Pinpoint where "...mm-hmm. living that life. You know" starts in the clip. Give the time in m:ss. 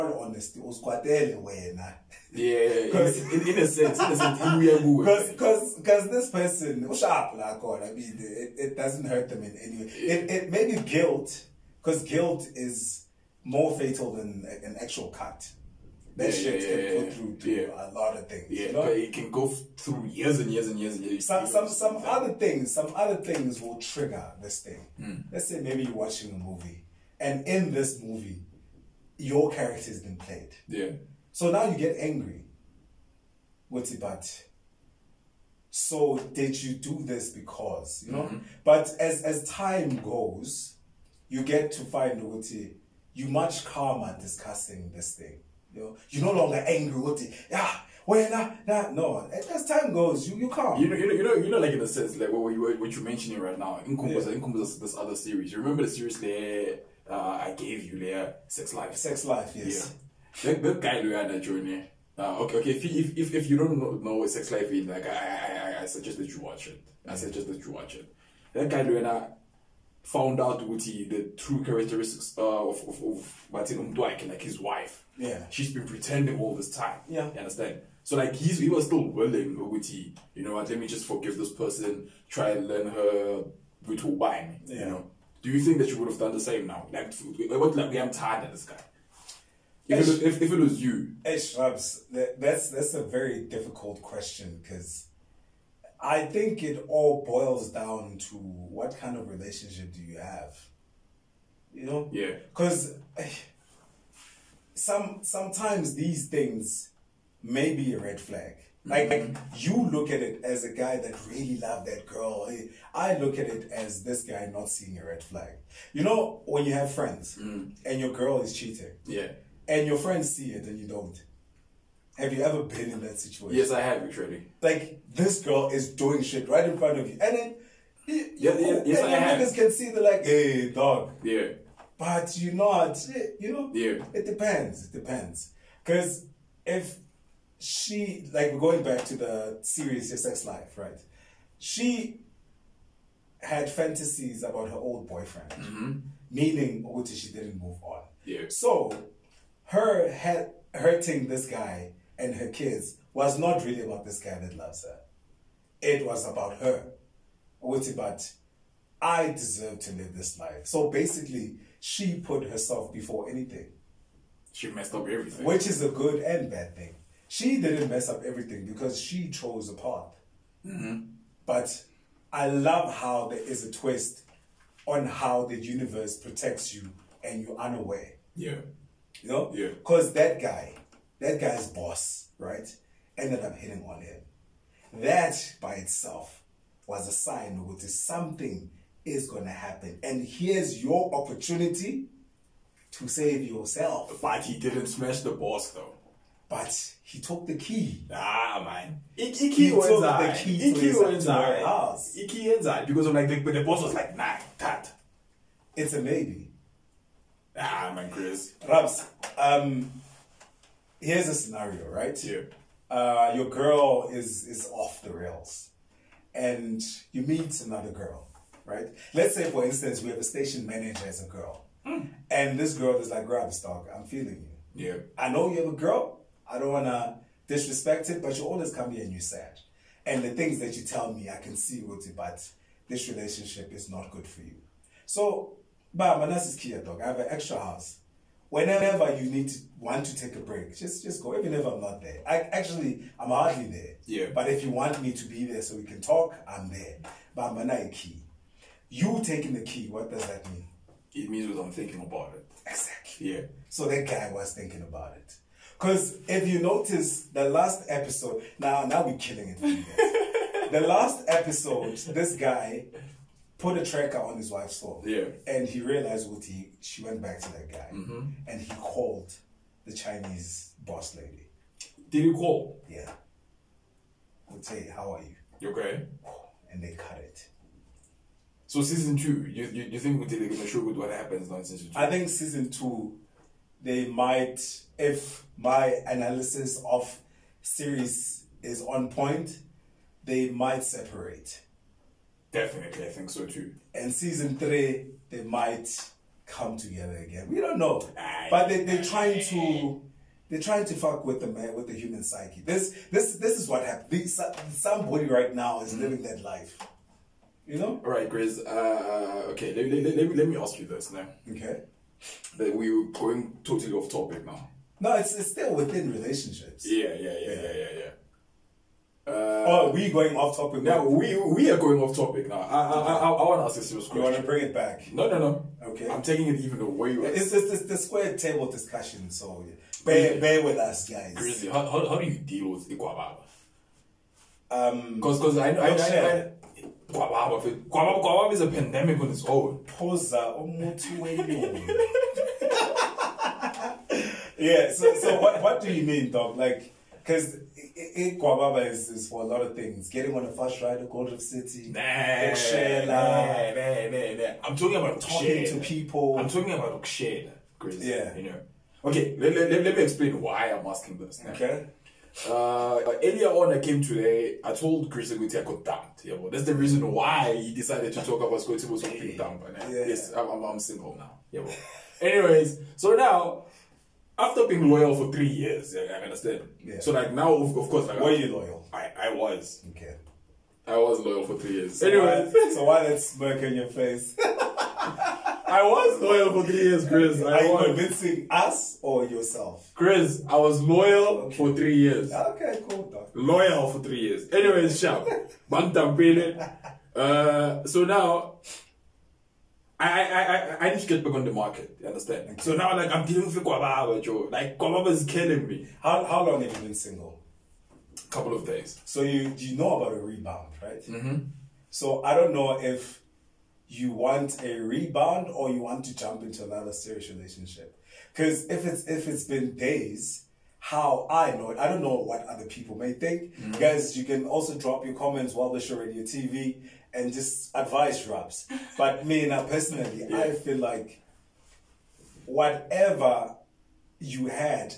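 5:05.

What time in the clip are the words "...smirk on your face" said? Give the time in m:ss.
6:23.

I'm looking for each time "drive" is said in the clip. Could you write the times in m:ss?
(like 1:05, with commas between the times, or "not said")
not said.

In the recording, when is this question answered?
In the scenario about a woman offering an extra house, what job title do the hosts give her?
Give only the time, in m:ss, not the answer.
3:40.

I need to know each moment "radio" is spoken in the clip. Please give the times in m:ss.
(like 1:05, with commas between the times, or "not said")
7:05.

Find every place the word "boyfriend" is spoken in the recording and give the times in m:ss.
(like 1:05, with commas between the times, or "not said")
2:25.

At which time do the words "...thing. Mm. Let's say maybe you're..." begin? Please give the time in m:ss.
0:24.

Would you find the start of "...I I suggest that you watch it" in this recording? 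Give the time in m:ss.
1:05.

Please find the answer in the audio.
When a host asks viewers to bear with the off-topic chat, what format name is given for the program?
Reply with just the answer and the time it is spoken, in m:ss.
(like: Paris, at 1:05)
square table discussion, at 5:27.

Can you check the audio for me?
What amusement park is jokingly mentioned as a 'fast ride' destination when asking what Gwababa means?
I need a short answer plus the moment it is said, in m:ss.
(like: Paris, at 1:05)
Gold Reef City, at 5:51.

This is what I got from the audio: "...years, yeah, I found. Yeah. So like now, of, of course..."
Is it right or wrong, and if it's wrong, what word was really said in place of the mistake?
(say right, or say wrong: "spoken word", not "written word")
wrong: "understand", not "found".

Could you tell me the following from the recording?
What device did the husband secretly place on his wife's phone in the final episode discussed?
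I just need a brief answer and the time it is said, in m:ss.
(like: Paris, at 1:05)
a tracker, at 4:23.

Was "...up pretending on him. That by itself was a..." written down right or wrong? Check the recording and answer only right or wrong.
wrong.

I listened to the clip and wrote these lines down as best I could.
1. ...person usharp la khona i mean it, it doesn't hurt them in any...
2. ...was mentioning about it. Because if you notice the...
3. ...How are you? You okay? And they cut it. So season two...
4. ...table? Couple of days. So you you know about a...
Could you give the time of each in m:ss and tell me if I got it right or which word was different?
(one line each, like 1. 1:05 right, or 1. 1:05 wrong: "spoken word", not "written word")
1. 0:06 right
2. 4:14 wrong: "thinking", not "mentioning"
3. 4:34 right
4. 6:46 wrong: "single", not "table".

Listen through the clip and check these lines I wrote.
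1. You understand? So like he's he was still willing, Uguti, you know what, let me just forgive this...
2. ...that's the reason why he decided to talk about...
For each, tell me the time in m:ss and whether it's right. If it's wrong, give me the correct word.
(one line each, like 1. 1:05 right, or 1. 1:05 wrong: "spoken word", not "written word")
1. 1:17 right
2. 6:06 right.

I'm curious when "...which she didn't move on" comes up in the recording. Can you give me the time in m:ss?
2:26.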